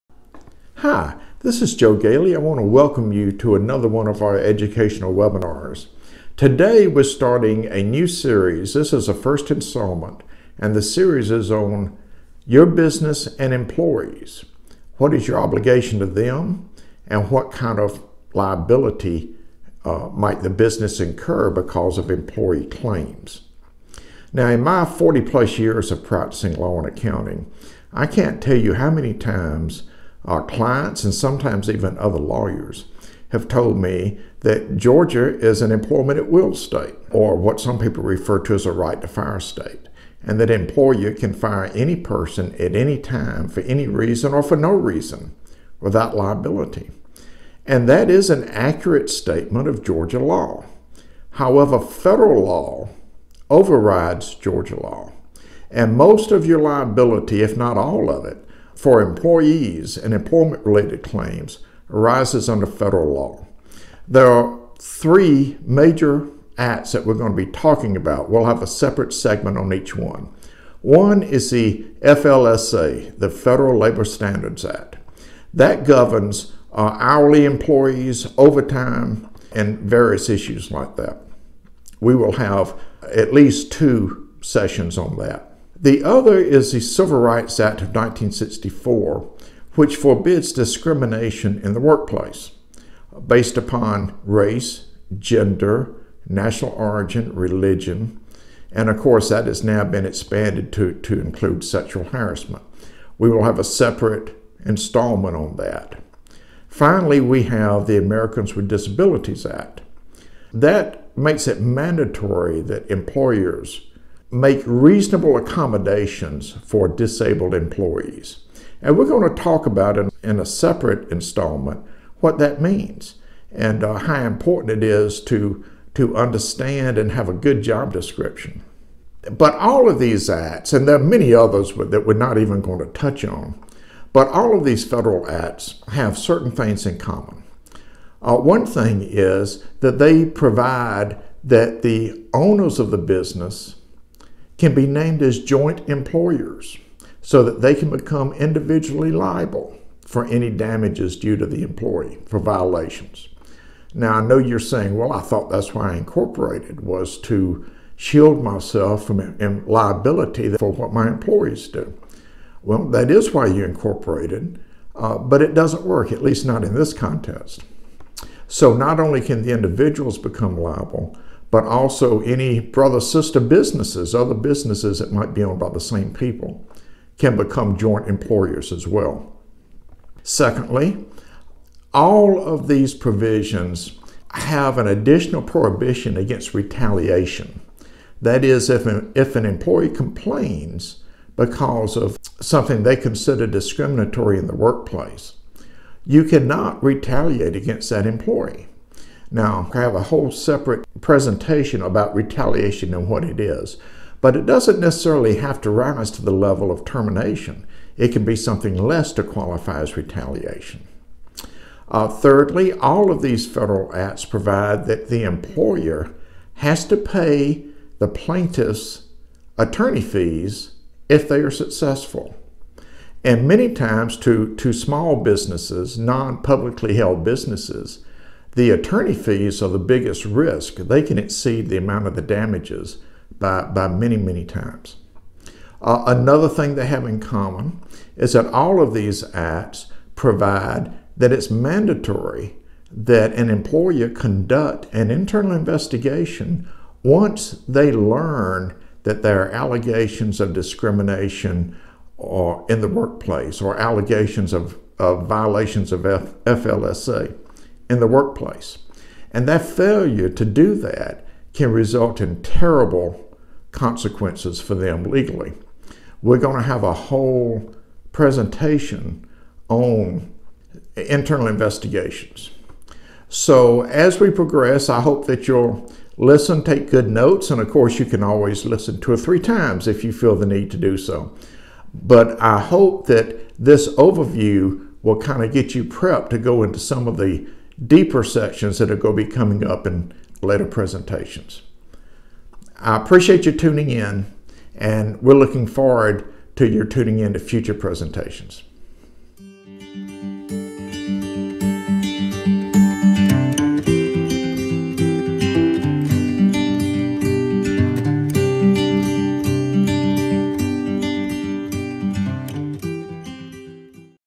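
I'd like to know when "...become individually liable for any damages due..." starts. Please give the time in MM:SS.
02:27.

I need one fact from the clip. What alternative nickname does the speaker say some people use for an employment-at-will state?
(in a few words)
right to fire state.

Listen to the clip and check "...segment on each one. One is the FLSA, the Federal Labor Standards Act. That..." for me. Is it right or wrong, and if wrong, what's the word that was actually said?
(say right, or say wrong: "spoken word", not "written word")
right.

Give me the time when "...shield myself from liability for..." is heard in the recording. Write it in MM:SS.
02:37.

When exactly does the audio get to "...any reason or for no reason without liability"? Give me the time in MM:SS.
00:43.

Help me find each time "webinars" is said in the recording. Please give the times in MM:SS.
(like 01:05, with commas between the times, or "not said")
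00:05.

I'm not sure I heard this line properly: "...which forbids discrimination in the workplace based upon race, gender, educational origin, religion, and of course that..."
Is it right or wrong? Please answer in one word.
wrong.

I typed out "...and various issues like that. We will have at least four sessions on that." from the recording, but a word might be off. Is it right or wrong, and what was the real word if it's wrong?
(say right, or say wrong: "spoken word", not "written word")
wrong: "two", not "four".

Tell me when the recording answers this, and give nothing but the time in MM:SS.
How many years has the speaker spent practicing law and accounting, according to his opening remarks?
00:24.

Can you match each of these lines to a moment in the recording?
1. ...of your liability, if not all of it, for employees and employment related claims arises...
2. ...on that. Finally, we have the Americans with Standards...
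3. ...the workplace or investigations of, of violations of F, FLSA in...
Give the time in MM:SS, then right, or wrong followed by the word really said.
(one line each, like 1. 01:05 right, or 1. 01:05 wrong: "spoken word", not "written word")
1. 00:56 right
2. 01:45 wrong: "Disabilities", not "Standards"
3. 04:12 wrong: "allegations", not "investigations".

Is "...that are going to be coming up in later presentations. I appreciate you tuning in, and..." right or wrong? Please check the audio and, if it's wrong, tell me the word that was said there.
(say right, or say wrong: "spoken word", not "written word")
right.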